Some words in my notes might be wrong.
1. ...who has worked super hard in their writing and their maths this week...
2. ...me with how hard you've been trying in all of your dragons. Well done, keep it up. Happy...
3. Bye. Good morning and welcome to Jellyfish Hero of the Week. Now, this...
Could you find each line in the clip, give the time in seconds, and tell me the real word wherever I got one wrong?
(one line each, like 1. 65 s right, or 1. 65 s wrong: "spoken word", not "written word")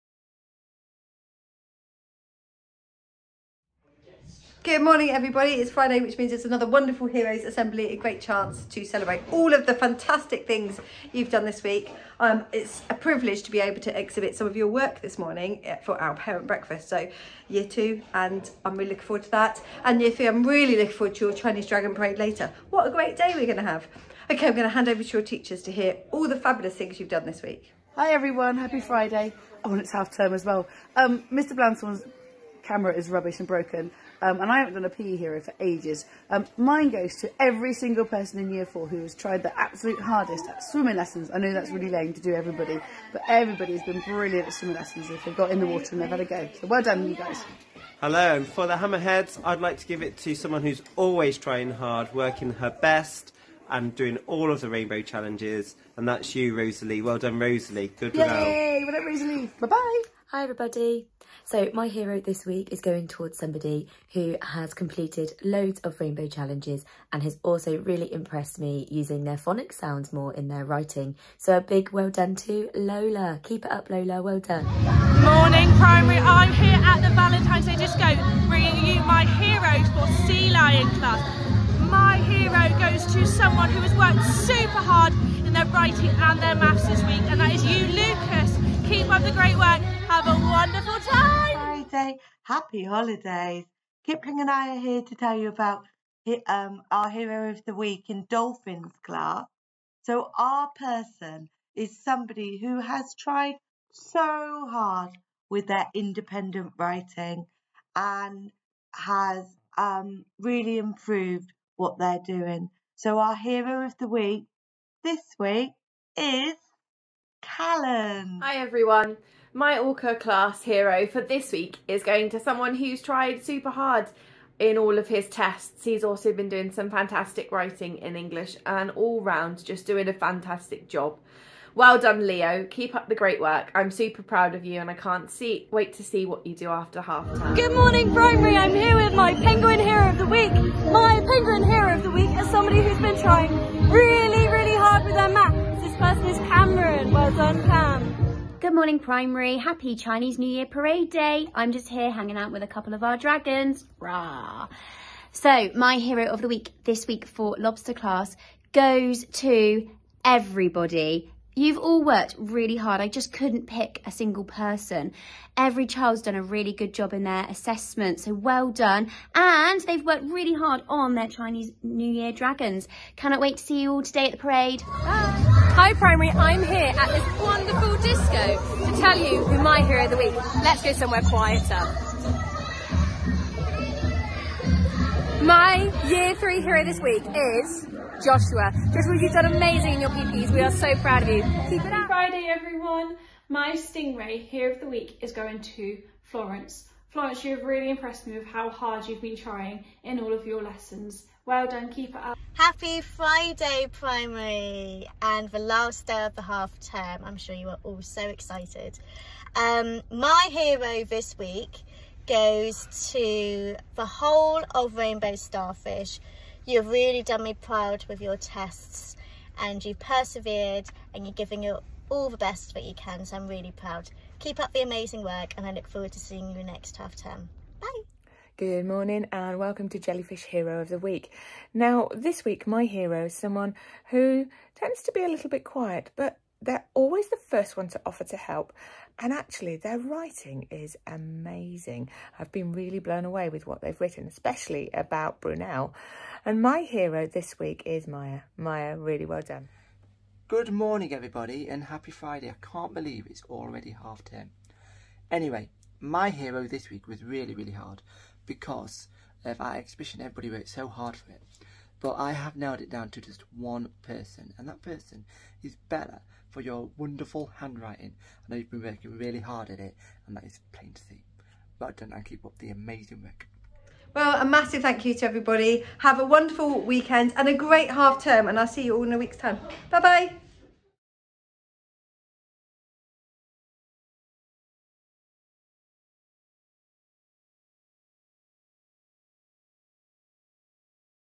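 1. 83 s right
2. 198 s wrong: "lessons", not "dragons"
3. 227 s right.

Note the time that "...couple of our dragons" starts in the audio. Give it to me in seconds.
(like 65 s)
152 s.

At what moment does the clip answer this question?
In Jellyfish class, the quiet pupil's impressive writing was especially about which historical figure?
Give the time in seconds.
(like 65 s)
245 s.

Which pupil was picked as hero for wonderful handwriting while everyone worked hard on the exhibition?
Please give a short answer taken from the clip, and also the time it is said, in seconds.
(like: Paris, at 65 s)
Bella, at 265 s.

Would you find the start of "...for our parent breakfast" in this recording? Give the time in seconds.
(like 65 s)
15 s.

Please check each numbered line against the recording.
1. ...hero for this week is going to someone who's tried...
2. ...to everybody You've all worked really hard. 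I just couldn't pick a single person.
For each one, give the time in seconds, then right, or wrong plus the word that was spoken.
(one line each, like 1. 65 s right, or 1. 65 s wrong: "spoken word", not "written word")
1. 120 s right
2. 159 s right.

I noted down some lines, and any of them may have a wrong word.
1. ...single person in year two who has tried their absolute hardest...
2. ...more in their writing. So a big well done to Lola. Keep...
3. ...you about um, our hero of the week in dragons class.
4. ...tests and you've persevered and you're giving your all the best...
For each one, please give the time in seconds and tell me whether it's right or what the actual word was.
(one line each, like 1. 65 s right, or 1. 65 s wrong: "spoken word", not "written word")
1. 37 s wrong: "four", not "two"
2. 70 s right
3. 95 s wrong: "dolphins", not "dragons"
4. 218 s right.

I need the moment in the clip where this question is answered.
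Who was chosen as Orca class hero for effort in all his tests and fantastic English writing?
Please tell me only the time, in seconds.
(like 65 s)
132 s.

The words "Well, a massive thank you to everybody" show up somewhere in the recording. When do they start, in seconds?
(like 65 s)
274 s.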